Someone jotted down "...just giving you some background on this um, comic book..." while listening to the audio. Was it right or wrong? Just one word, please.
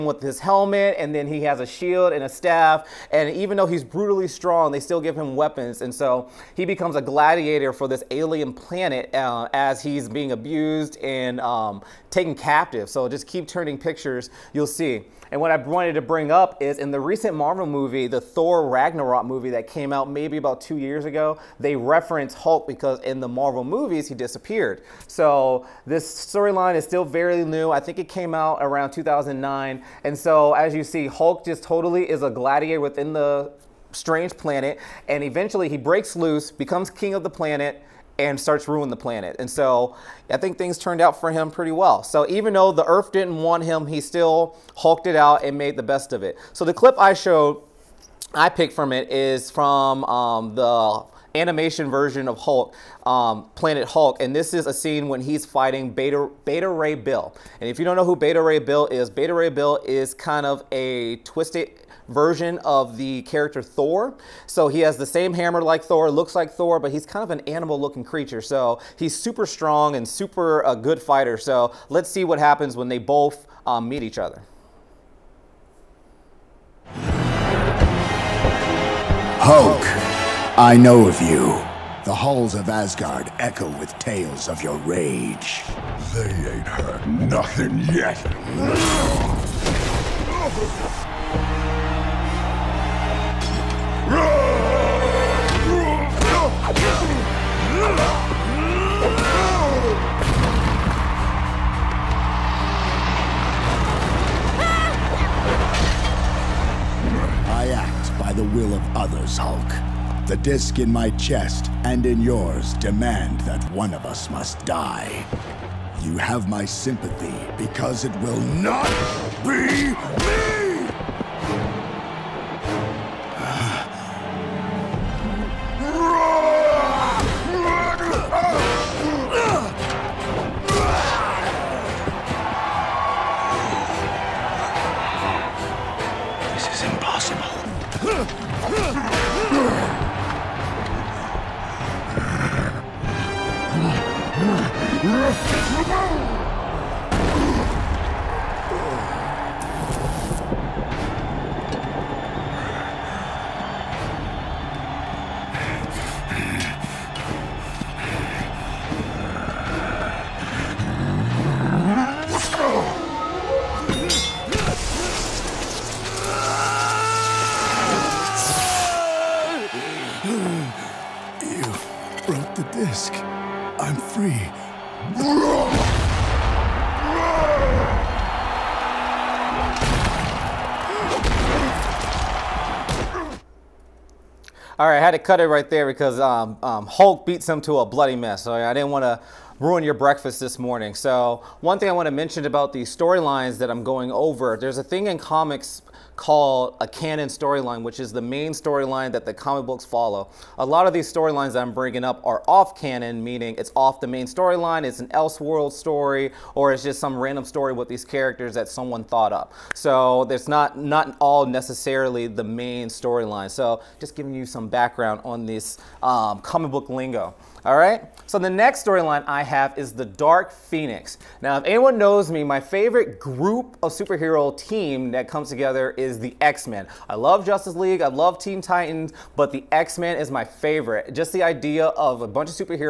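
right.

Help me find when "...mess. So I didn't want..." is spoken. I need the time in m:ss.
3:08.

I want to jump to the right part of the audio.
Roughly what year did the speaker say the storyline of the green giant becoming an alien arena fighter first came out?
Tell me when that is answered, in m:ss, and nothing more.
0:28.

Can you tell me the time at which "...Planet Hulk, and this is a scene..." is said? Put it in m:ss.
0:53.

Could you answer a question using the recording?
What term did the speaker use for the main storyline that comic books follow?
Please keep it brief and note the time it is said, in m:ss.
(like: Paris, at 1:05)
canon storyline, at 3:16.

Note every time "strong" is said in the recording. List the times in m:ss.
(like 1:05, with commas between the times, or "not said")
0:04, 1:09.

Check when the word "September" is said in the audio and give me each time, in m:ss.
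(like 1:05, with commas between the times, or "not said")
not said.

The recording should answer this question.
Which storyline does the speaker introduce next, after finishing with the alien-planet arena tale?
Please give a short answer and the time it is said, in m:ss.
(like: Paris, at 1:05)
The Dark Phoenix, at 3:39.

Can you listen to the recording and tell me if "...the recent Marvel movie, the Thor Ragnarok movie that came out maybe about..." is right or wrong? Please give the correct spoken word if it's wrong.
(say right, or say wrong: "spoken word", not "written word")
right.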